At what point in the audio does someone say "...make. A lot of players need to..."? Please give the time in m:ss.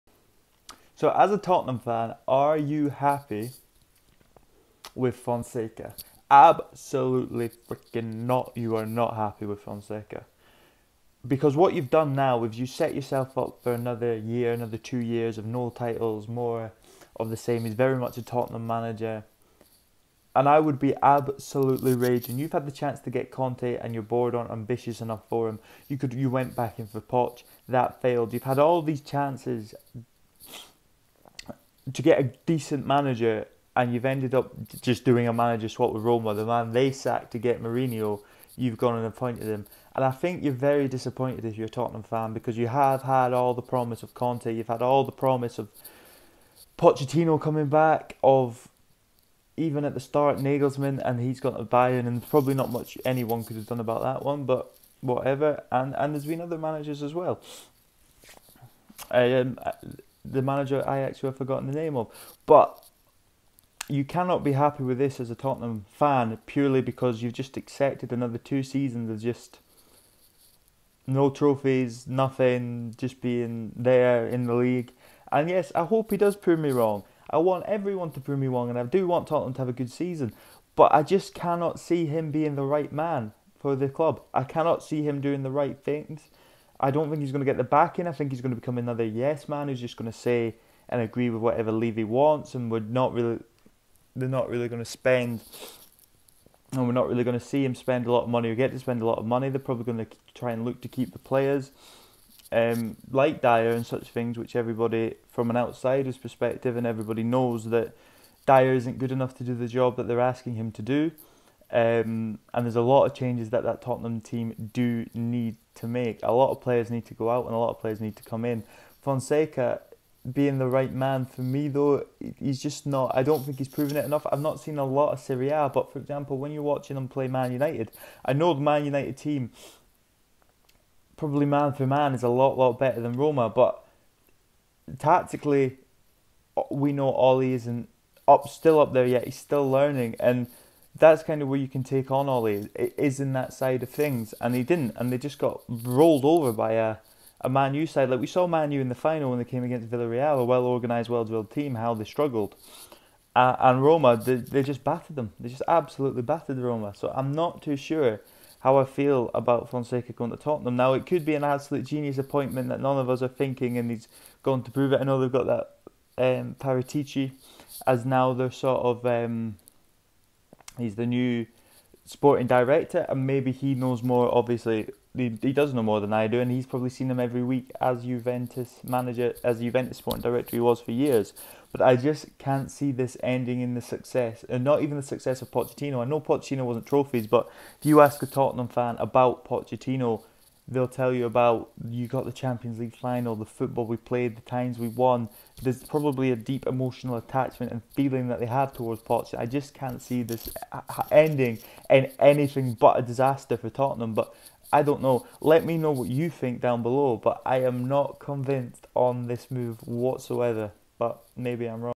1:55.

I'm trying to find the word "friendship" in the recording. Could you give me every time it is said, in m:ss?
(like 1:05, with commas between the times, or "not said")
not said.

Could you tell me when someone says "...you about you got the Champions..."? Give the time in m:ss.
3:11.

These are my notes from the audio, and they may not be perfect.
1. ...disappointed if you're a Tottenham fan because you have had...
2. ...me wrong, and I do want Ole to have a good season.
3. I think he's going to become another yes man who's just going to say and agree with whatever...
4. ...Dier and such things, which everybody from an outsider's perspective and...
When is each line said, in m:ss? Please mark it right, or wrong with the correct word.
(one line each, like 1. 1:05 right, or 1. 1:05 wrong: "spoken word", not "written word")
1. 0:40 right
2. 1:18 wrong: "Tottenham", not "Ole"
3. 1:28 right
4. 1:43 right.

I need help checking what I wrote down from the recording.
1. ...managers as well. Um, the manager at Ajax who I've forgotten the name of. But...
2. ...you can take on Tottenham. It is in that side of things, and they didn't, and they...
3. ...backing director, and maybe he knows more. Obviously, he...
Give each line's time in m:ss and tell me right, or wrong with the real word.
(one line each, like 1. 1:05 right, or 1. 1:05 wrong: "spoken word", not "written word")
1. 0:56 right
2. 2:21 wrong: "Ole", not "Tottenham"
3. 2:52 wrong: "sporting", not "backing".